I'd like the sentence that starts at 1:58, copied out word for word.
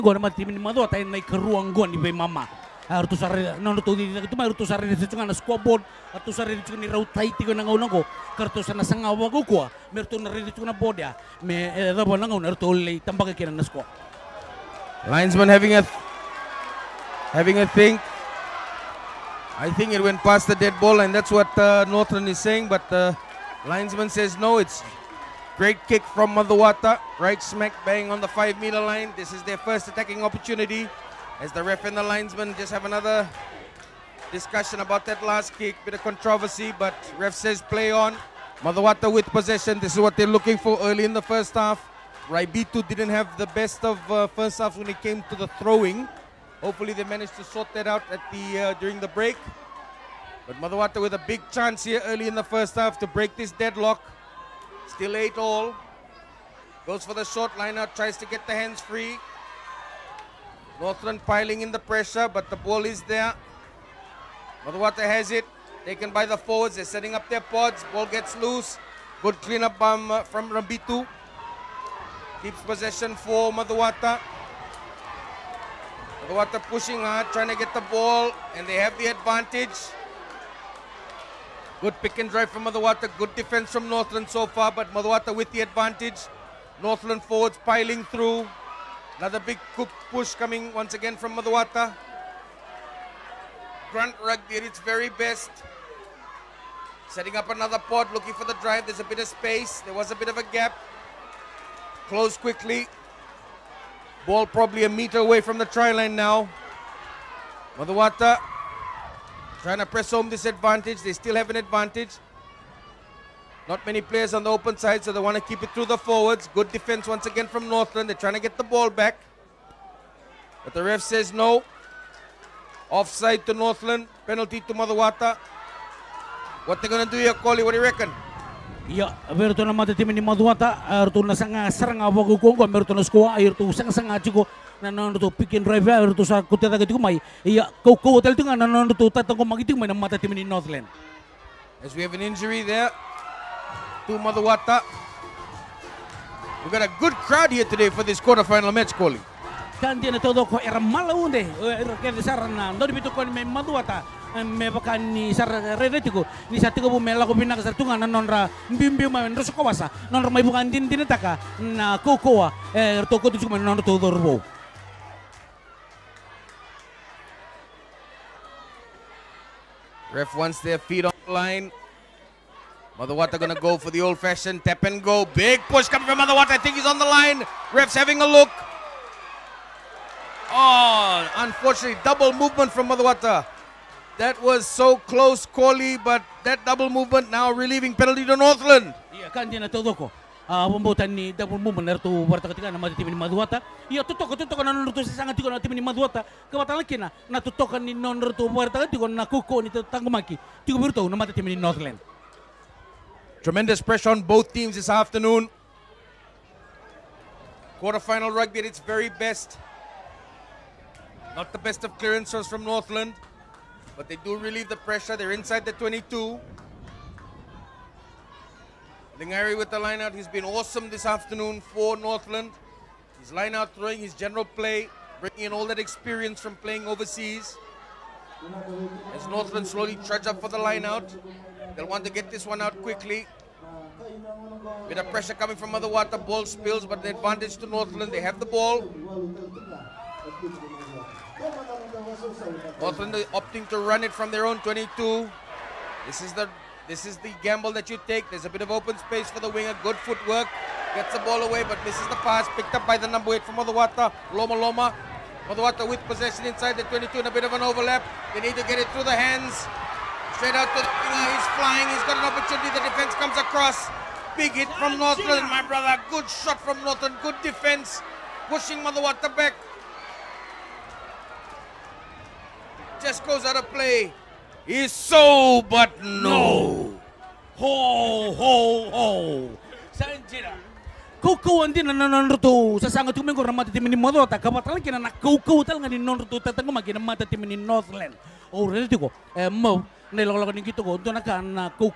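They're trying to get the ball back.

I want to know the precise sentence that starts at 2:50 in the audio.
Ref wants their feet on the line.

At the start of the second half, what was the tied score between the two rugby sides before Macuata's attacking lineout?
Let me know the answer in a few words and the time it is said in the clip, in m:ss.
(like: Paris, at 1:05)
8 all, at 0:55.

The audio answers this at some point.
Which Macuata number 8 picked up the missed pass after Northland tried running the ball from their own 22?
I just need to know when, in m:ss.
4:14.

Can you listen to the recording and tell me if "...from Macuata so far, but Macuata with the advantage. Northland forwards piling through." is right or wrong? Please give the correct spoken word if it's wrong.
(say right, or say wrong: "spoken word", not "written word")
wrong: "Northland", not "Macuata".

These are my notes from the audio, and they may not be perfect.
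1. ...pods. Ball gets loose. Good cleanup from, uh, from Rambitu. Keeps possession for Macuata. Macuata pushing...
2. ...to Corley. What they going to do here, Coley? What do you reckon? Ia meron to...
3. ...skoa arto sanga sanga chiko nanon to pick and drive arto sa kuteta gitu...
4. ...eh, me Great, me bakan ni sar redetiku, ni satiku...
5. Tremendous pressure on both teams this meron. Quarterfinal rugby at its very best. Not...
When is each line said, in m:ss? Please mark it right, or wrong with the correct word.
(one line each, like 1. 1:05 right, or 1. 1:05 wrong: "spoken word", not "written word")
1. 1:07 right
2. 2:04 wrong: "Macuata", not "Corley"
3. 2:13 right
4. 2:33 wrong: "Madhuwata", not "Great"
5. 3:23 wrong: "afternoon", not "meron".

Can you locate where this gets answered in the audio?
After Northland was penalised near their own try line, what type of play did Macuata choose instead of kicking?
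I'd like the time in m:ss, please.
2:54.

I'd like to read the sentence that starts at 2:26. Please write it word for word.
We got a good crowd here today for this quarterfinal match, Koli.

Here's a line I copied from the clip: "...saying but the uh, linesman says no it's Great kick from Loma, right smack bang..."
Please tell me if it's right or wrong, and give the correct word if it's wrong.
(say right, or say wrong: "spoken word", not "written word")
wrong: "Macuata", not "Loma".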